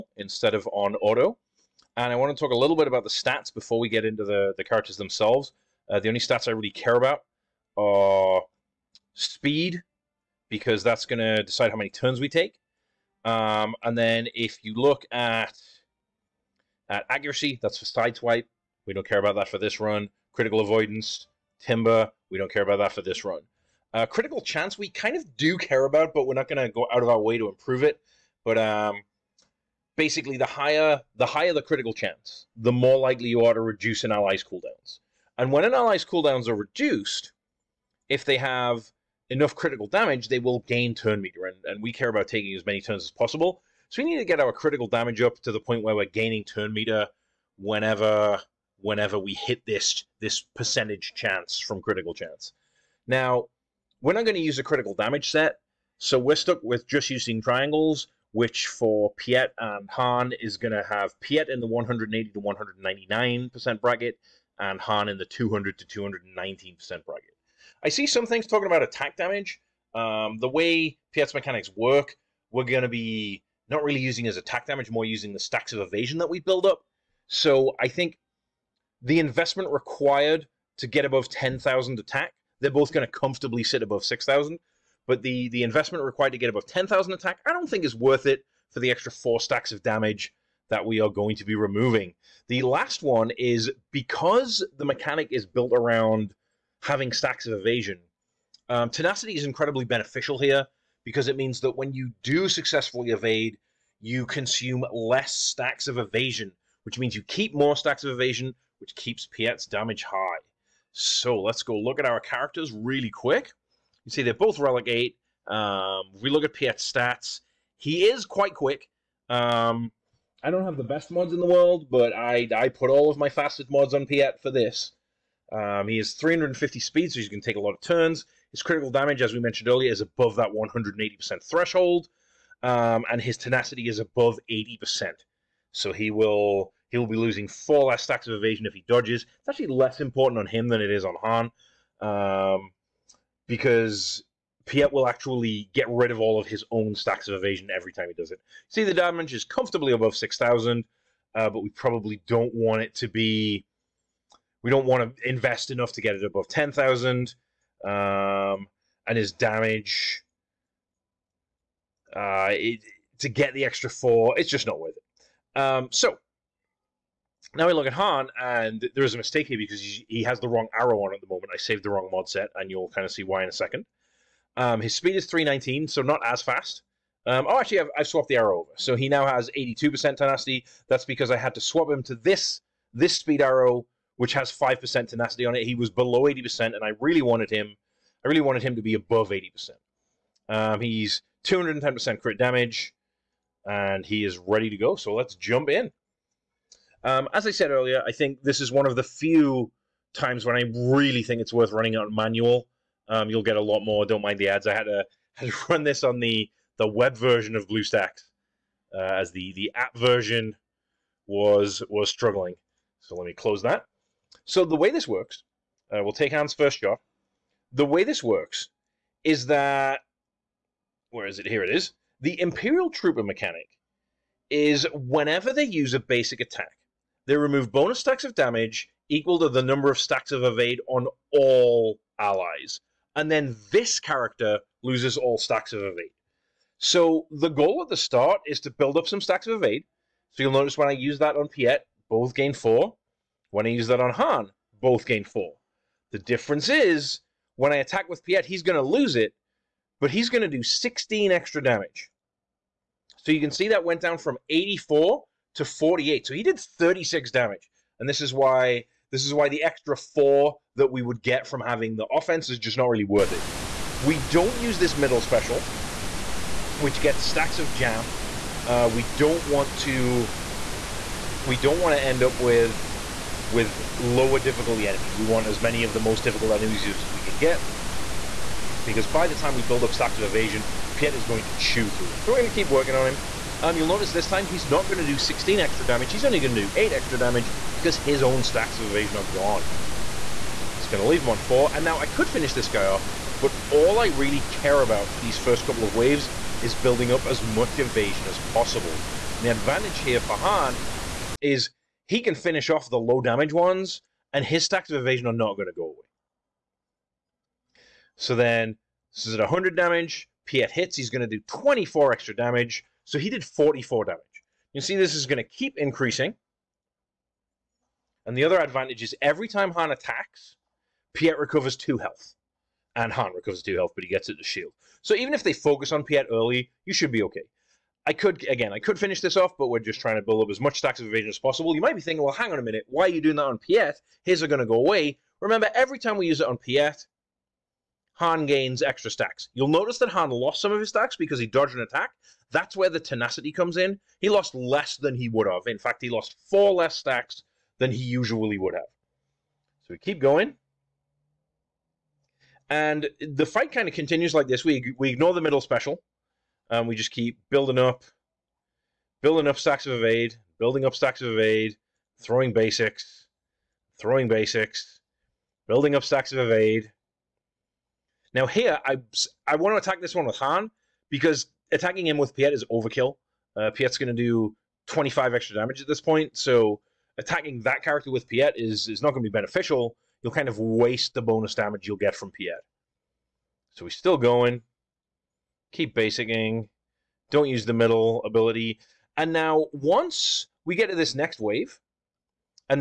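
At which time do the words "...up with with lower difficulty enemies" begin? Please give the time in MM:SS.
04:32.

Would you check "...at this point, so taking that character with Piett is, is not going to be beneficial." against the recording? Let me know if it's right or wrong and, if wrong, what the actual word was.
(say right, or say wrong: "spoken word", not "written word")
wrong: "attacking", not "taking".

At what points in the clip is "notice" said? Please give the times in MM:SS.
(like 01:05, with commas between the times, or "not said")
04:00, 04:43, 05:39.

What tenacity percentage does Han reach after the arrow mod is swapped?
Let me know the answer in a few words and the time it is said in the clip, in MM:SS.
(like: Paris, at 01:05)
82%, at 02:59.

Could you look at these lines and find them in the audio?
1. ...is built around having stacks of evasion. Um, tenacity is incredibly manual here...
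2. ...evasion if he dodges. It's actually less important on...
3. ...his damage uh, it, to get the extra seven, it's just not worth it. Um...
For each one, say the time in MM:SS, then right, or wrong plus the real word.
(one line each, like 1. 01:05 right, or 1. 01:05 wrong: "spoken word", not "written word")
1. 01:35 wrong: "beneficial", not "manual"
2. 02:18 right
3. 02:39 wrong: "four", not "seven".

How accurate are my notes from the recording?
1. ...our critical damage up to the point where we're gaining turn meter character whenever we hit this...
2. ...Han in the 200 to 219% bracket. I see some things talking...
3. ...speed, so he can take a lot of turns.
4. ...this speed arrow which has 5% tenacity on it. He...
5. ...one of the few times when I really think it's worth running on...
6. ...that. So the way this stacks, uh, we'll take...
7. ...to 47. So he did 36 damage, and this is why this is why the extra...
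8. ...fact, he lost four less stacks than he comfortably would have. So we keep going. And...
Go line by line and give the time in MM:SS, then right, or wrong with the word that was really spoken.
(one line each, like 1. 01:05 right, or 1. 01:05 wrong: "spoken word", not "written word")
1. 00:44 wrong: "whenever", not "character"
2. 01:04 right
3. 02:06 right
4. 03:02 right
5. 03:18 right
6. 03:33 wrong: "works", not "stacks"
7. 04:15 wrong: "48", not "47"
8. 05:45 wrong: "usually", not "comfortably".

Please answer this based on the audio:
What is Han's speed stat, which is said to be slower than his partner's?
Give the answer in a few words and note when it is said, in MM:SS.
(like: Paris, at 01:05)
319, at 02:55.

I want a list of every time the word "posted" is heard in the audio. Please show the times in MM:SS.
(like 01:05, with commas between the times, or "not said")
not said.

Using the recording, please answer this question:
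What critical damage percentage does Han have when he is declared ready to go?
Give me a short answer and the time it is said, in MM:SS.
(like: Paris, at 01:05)
210%, at 03:11.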